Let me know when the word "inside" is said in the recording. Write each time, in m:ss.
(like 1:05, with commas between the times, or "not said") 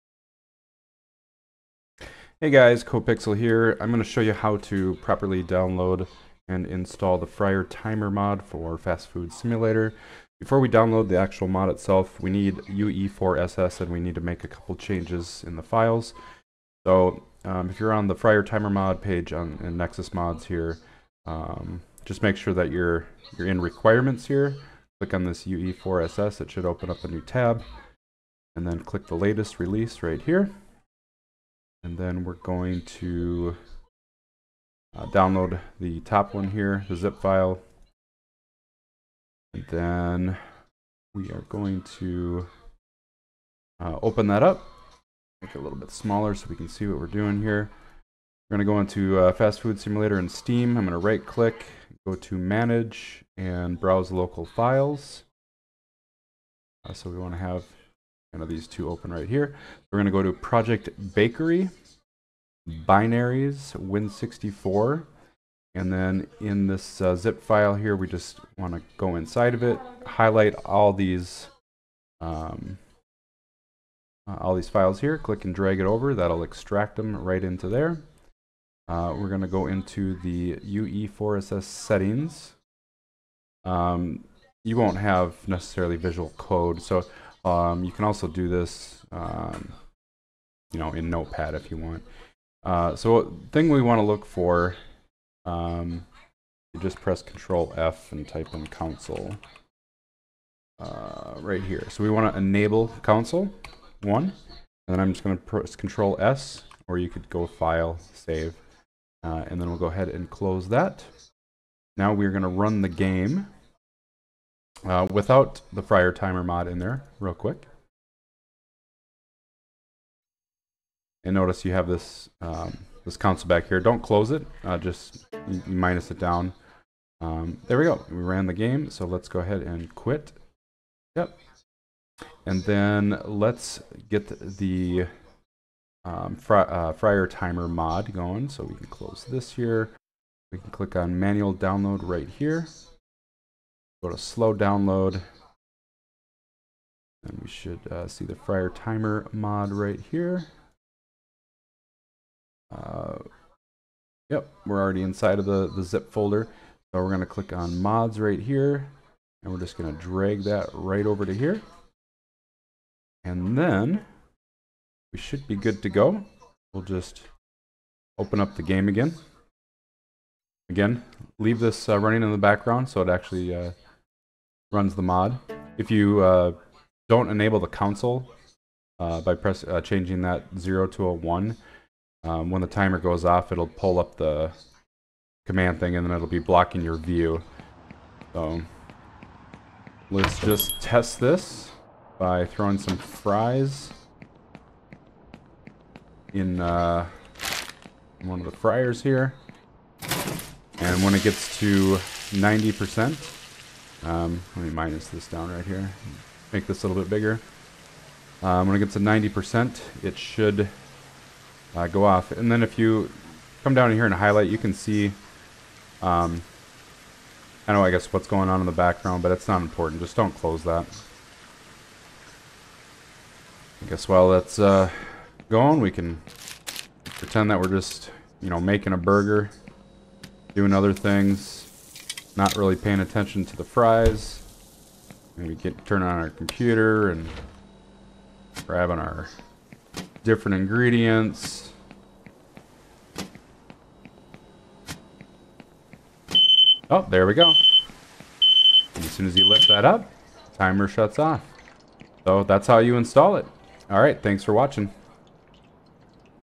1:09, 2:35.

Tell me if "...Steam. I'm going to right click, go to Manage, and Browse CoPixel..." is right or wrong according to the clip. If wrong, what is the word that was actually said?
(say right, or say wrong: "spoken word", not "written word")
wrong: "Local", not "CoPixel".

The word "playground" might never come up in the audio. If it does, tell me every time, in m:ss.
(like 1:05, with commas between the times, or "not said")
not said.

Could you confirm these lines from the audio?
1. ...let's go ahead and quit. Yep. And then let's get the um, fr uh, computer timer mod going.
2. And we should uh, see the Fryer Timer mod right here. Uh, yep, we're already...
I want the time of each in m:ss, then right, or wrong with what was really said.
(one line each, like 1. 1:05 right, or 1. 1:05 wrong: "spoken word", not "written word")
1. 2:09 wrong: "fryer", not "computer"
2. 2:27 right.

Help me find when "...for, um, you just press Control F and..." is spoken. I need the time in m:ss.
1:34.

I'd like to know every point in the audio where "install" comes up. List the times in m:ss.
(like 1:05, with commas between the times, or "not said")
0:06, 4:12.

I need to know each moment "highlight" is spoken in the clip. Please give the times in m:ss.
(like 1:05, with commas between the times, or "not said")
1:10, 3:34.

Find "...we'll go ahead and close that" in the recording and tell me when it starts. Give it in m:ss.
1:49.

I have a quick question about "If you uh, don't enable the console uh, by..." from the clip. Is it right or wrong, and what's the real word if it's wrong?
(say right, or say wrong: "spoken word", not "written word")
right.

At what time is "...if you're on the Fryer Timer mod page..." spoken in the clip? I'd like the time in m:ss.
0:17.